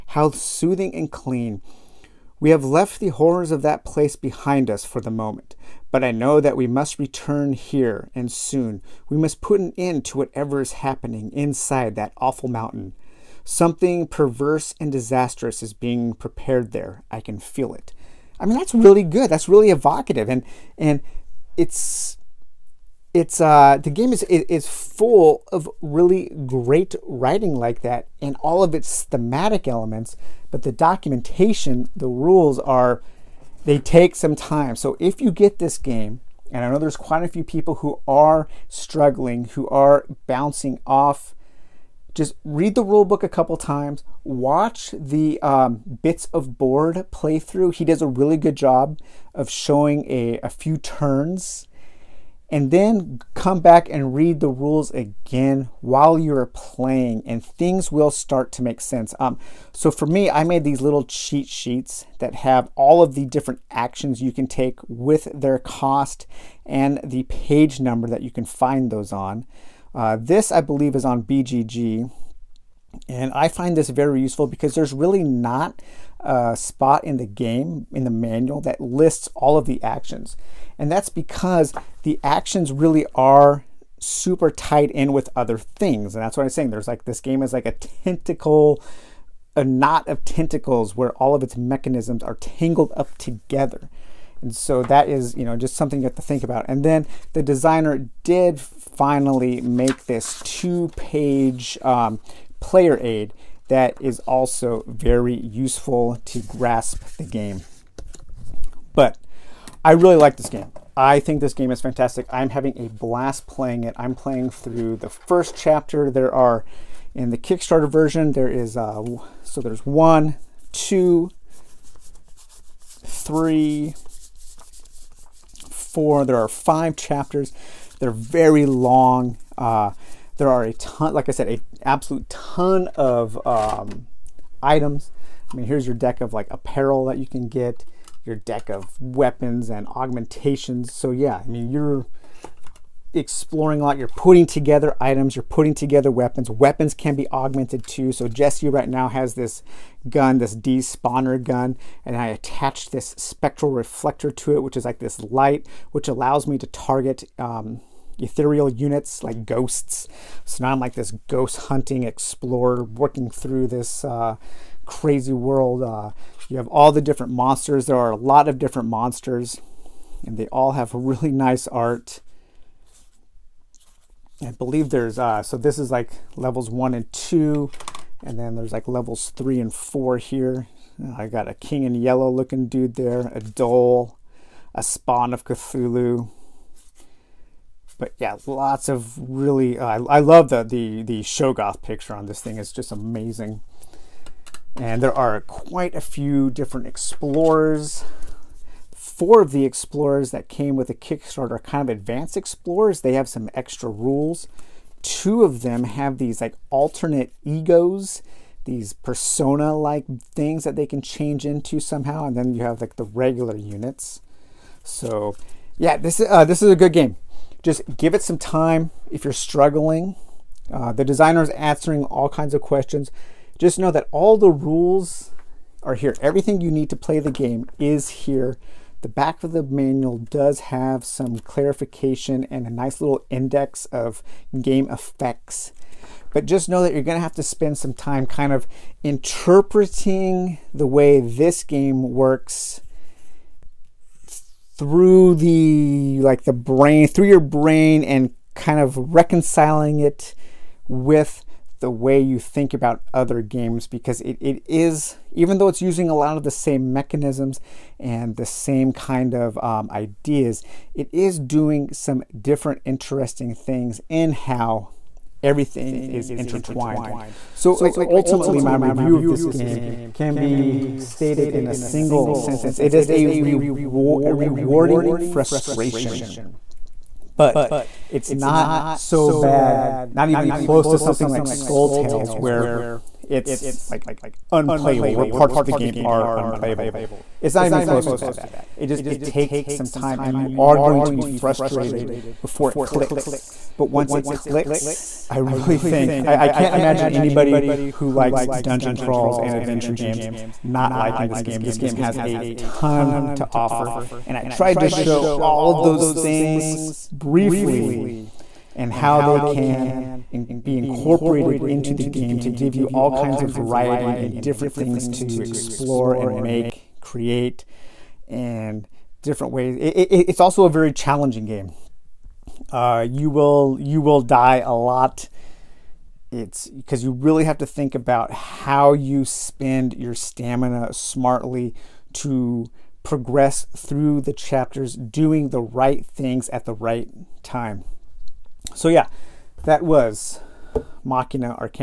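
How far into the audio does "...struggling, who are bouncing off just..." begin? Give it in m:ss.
0:38.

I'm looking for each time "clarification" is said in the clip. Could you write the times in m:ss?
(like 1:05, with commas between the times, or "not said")
3:51.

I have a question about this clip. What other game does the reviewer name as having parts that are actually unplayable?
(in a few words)
Skull Tales.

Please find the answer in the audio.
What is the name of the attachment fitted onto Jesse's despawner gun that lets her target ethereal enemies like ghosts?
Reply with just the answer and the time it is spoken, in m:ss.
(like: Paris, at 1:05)
Spectral reflector, at 2:33.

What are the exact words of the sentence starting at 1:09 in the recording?
Uh, this, I believe, is on BGG.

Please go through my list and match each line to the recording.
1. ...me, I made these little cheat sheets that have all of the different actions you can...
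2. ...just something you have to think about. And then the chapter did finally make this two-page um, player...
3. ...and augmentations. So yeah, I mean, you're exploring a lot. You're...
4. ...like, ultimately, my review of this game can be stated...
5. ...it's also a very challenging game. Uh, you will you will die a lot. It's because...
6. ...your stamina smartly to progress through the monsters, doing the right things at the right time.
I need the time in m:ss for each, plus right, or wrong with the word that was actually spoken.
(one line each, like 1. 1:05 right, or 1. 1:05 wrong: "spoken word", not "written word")
1. 1:00 right
2. 1:35 wrong: "designer", not "chapter"
3. 2:19 right
4. 4:27 right
5. 5:20 right
6. 5:29 wrong: "chapters", not "monsters".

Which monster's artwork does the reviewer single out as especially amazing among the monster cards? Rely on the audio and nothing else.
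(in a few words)
Shoggoth.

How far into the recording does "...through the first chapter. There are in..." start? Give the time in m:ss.
1:54.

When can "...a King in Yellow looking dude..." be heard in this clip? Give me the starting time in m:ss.
3:01.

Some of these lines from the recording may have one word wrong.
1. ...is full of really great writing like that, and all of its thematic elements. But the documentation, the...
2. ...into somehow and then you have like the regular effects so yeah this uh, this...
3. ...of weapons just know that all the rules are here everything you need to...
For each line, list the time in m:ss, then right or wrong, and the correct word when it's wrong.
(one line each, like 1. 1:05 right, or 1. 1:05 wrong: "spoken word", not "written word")
1. 0:24 right
2. 3:31 wrong: "units", not "effects"
3. 3:42 wrong: "questions", not "weapons".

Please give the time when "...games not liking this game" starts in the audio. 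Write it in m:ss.
4:59.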